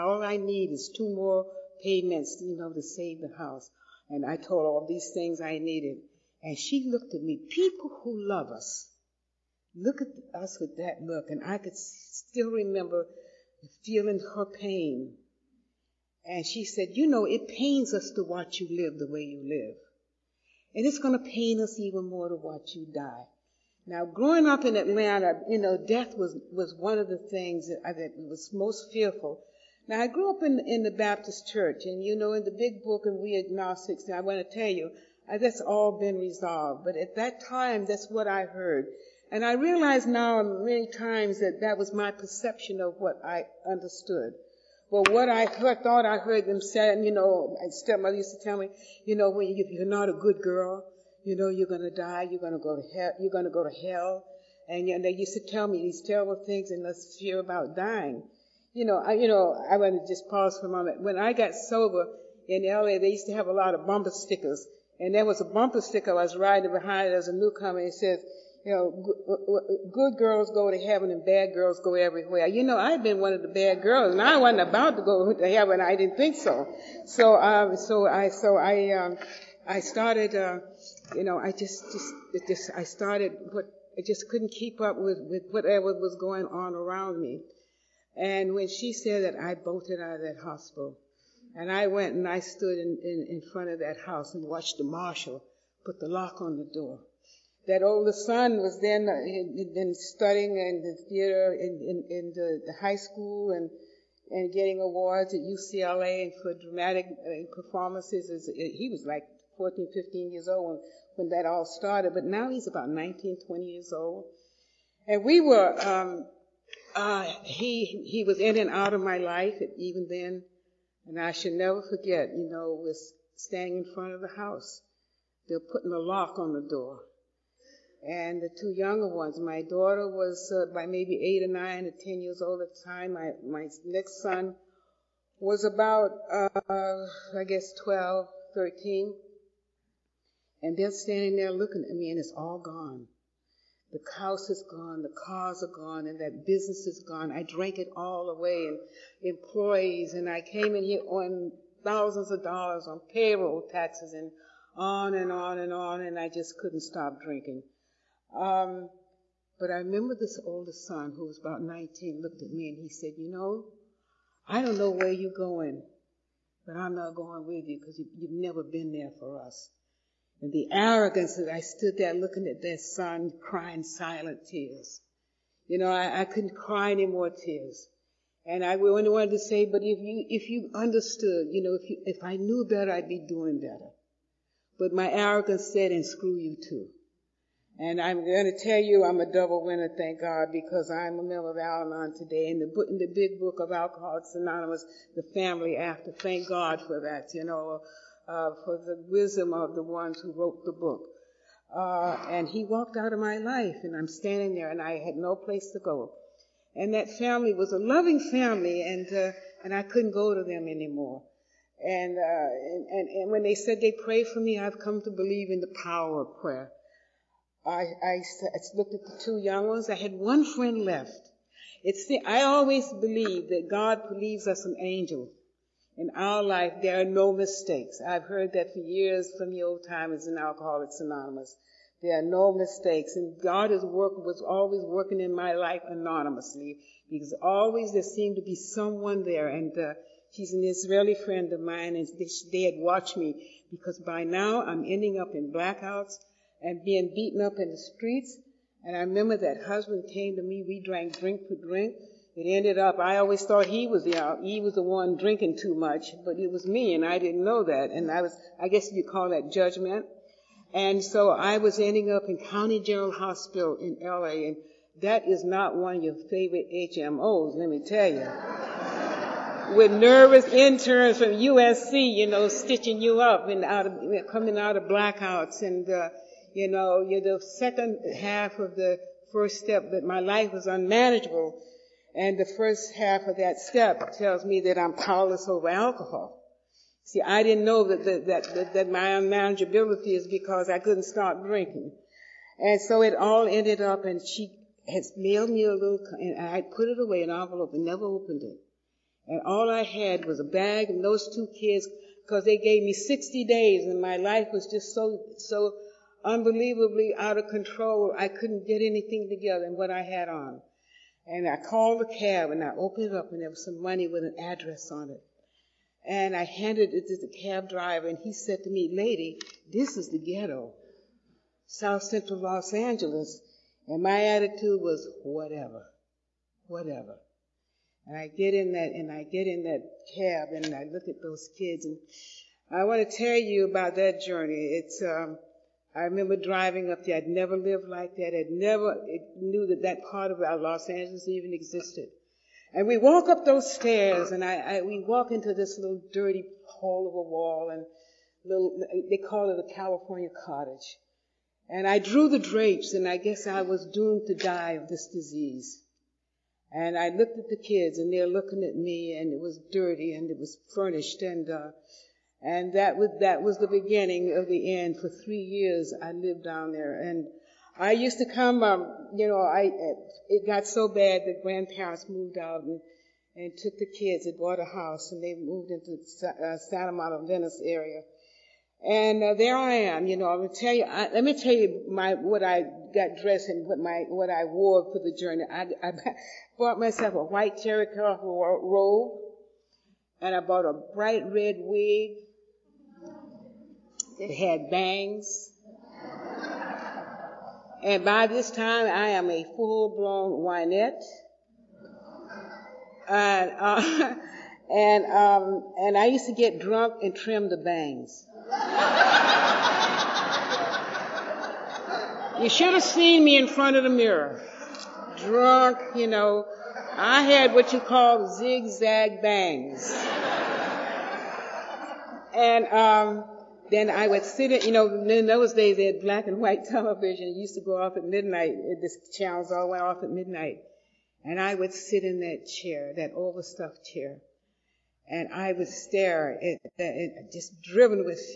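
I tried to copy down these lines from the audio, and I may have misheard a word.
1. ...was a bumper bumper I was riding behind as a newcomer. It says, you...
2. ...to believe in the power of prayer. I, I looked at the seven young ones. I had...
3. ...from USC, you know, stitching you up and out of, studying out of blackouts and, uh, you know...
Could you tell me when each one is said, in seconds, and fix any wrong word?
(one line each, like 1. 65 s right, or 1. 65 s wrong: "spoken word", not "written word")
1. 65 s wrong: "sticker", not "bumper"
2. 215 s wrong: "two", not "seven"
3. 271 s wrong: "coming", not "studying".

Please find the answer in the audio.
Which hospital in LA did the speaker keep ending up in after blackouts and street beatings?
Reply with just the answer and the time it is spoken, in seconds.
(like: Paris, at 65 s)
County General Hospital, at 262 s.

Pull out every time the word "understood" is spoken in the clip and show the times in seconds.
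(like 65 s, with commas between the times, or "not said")
43 s, 180 s.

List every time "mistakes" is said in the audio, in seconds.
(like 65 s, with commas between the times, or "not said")
227 s, 232 s.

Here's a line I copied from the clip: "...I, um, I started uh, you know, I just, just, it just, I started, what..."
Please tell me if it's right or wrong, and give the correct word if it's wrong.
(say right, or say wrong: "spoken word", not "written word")
right.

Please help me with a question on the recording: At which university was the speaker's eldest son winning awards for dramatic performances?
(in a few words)
UCLA.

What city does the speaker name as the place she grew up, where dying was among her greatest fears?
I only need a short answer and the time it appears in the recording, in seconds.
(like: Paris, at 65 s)
Atlanta, at 24 s.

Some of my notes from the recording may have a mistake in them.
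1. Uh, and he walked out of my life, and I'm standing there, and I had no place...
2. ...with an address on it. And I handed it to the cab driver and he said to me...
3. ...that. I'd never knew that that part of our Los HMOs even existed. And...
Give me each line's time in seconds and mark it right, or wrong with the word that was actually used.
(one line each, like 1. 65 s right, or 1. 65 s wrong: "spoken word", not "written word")
1. 201 s right
2. 314 s right
3. 338 s wrong: "Angeles", not "HMOs".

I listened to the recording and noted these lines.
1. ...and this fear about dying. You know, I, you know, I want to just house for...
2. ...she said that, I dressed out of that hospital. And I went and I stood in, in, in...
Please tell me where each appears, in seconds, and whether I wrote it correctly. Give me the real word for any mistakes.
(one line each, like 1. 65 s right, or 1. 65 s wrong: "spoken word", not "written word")
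1. 56 s wrong: "pause", not "house"
2. 88 s wrong: "bolted", not "dressed".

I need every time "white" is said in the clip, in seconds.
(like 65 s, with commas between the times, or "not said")
387 s, 426 s.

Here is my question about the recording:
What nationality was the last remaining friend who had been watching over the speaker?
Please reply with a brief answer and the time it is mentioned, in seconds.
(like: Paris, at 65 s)
Israeli, at 240 s.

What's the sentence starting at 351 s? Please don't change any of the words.
And I drew the drapes, and I guess I was doomed to die of this disease.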